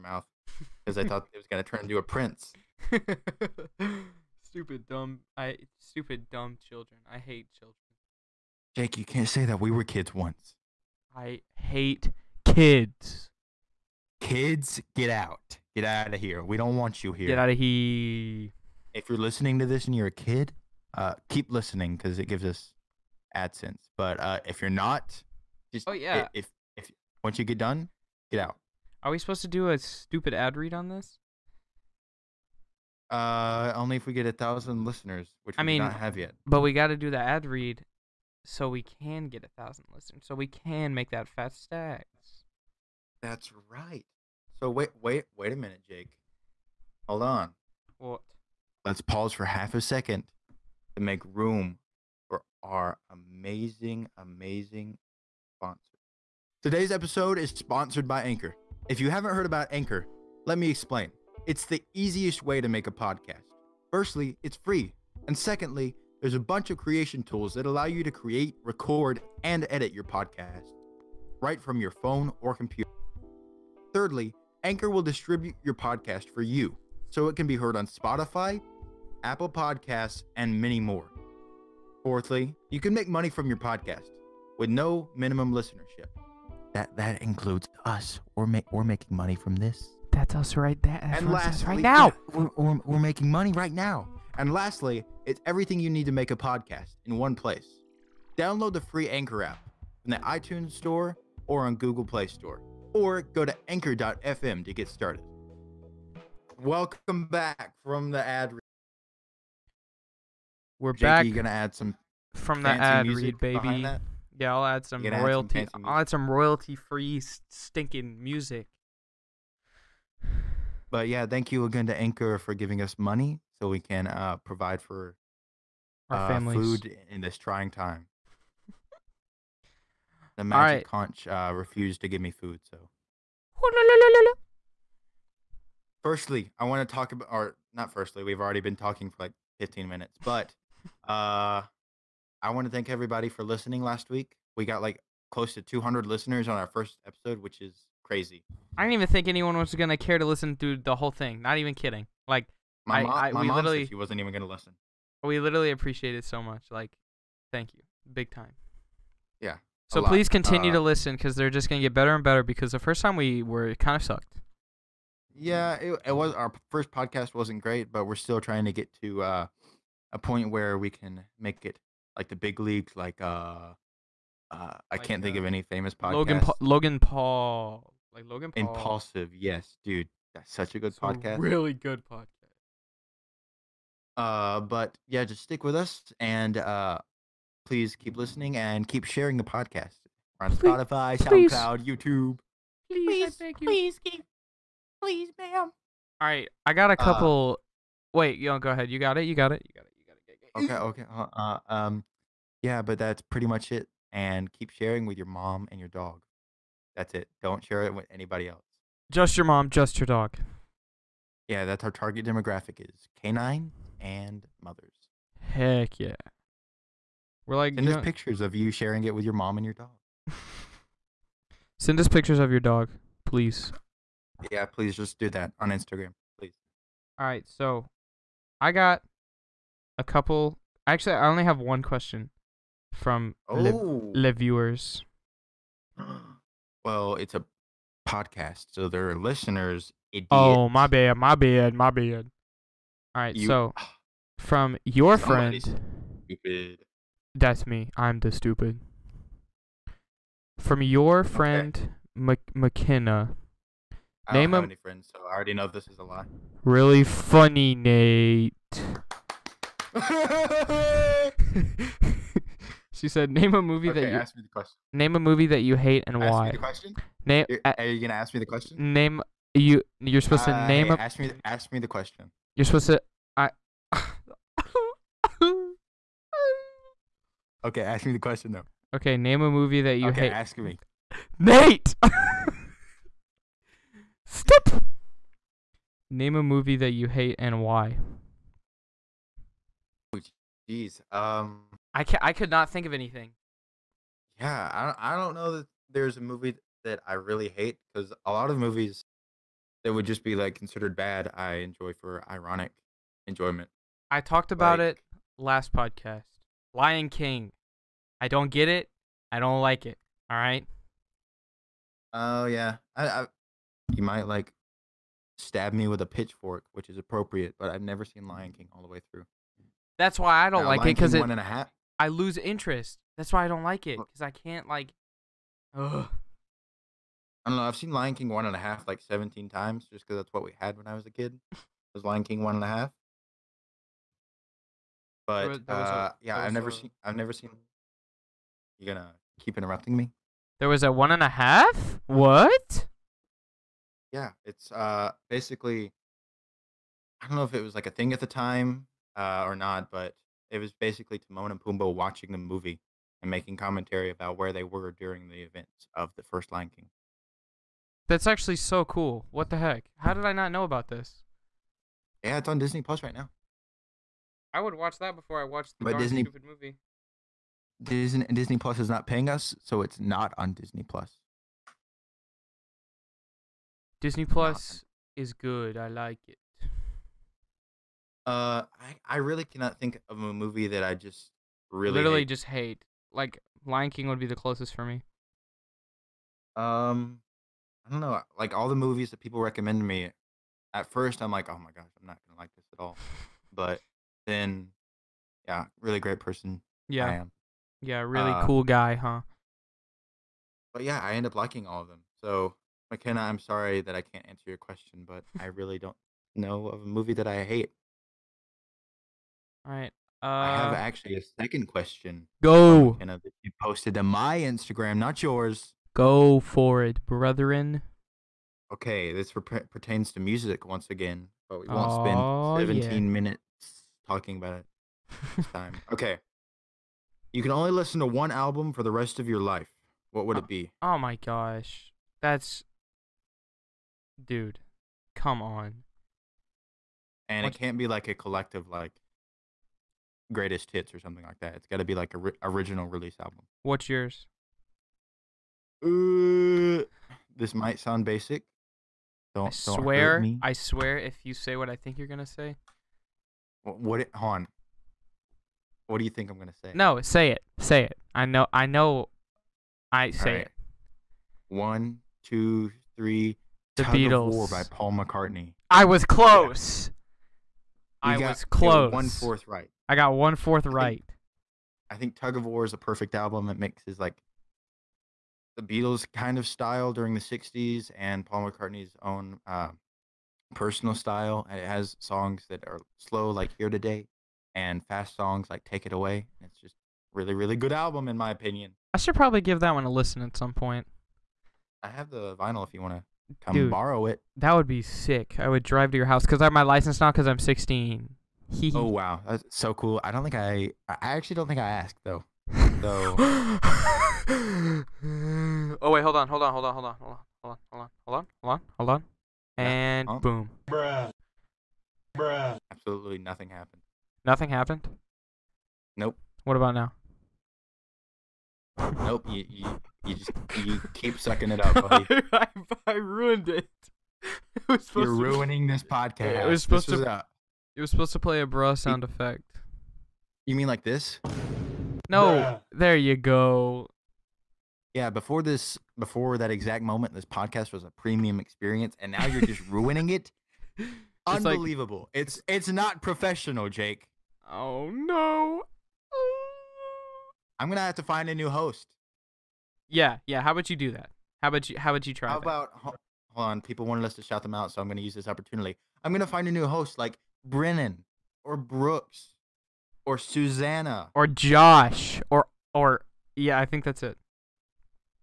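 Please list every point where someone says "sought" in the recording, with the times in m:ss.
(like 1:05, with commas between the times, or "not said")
not said.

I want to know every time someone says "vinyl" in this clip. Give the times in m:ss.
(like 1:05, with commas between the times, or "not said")
8:12.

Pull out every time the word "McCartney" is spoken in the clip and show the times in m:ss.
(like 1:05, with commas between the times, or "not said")
7:44, 7:58.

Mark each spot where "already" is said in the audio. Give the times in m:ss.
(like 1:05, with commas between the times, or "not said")
2:18, 4:15.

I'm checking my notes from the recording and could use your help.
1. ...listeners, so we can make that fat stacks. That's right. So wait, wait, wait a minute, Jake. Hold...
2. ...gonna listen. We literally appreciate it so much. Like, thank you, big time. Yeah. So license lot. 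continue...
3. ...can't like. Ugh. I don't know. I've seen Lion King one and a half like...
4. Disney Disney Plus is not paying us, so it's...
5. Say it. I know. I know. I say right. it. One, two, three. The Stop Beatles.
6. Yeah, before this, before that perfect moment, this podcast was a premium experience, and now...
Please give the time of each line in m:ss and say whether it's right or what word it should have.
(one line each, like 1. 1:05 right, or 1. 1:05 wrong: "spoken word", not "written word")
1. 0:39 right
2. 2:34 wrong: "please", not "license"
3. 5:24 right
4. 6:07 right
5. 7:37 wrong: "Tug", not "Stop"
6. 8:54 wrong: "exact", not "perfect".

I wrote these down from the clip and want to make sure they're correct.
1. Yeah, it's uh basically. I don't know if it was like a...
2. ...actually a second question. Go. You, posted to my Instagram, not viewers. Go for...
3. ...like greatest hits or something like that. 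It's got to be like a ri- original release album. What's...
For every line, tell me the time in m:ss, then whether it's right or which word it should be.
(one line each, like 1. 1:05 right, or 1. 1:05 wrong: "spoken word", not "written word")
1. 5:44 right
2. 6:50 wrong: "yours", not "viewers"
3. 7:18 right.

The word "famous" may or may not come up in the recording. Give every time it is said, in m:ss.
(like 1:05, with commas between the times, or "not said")
2:55.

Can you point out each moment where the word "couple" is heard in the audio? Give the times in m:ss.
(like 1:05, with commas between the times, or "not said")
3:17, 3:50.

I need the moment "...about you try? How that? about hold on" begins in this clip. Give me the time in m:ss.
9:11.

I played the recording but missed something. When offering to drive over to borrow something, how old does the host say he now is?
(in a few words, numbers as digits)
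16.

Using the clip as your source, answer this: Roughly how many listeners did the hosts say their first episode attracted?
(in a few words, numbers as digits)
200.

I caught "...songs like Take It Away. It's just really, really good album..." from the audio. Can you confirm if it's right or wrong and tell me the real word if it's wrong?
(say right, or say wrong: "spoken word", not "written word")
right.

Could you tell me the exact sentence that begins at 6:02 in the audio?
Yeah, it's on Disney Plus right now.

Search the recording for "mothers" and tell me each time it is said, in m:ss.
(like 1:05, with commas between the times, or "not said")
3:34.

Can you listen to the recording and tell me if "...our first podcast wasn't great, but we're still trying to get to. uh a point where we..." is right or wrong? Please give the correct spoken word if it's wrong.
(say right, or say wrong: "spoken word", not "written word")
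right.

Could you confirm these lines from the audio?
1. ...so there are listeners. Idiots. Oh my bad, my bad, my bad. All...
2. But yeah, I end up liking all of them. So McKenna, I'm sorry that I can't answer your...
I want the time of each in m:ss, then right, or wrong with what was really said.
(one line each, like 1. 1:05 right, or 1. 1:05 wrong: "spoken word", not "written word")
1. 3:58 right
2. 6:40 right.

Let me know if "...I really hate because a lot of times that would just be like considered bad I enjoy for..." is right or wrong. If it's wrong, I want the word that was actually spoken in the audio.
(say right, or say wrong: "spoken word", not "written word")
wrong: "movies", not "times".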